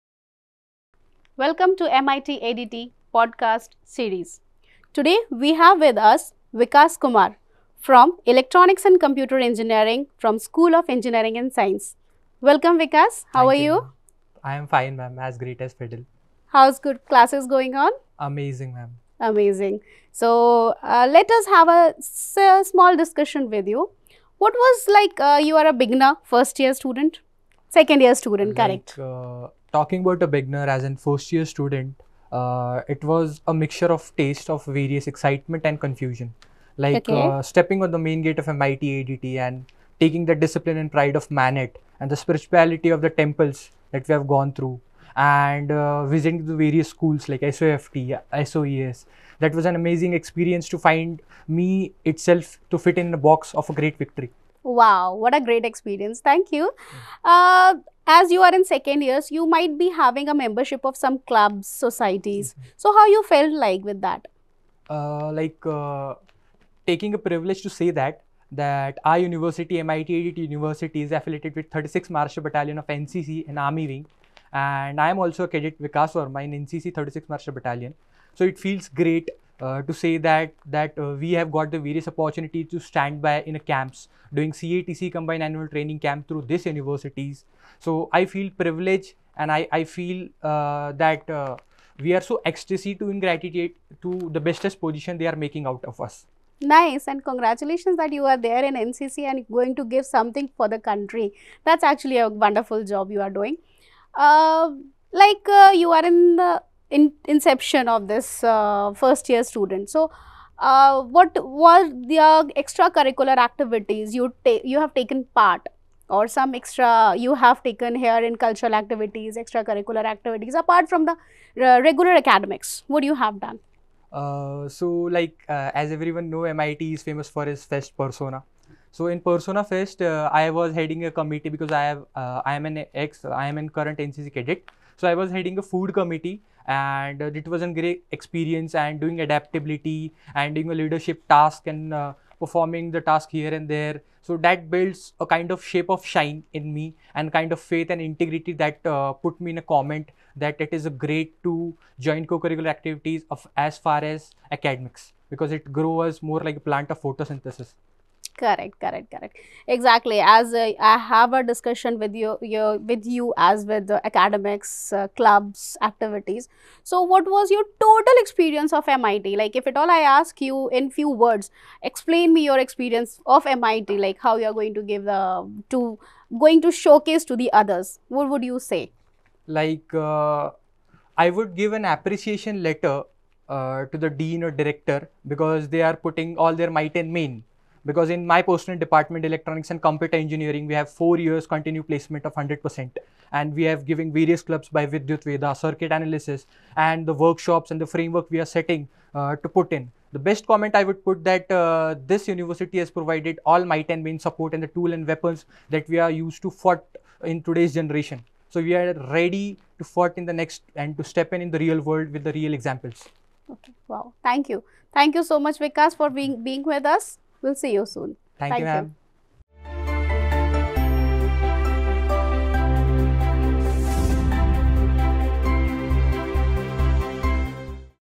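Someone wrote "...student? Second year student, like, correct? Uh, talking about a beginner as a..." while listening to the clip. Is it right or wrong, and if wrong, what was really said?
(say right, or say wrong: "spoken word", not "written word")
right.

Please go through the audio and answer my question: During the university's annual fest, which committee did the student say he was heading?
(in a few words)
Food committee.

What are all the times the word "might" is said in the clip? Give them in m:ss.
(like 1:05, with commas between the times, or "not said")
0:59, 3:06, 3:23.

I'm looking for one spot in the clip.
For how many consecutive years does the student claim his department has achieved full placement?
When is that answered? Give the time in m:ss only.
3:10.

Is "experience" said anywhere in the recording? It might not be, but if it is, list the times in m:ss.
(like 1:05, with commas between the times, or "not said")
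0:50, 0:55, 2:18, 2:48, 2:52.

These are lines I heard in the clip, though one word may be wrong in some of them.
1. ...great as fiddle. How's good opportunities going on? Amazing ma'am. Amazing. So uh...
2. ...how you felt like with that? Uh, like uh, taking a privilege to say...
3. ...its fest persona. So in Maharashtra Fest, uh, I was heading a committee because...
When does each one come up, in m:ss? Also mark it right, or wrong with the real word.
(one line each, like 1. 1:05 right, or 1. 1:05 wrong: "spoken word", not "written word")
1. 0:15 wrong: "classes", not "opportunities"
2. 1:02 right
3. 2:07 wrong: "Persona", not "Maharashtra".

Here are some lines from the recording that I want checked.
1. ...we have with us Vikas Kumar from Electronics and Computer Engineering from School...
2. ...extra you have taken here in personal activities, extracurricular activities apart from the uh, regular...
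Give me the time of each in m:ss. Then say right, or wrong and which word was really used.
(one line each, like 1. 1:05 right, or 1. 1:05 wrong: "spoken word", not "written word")
1. 0:05 right
2. 1:56 wrong: "cultural", not "personal".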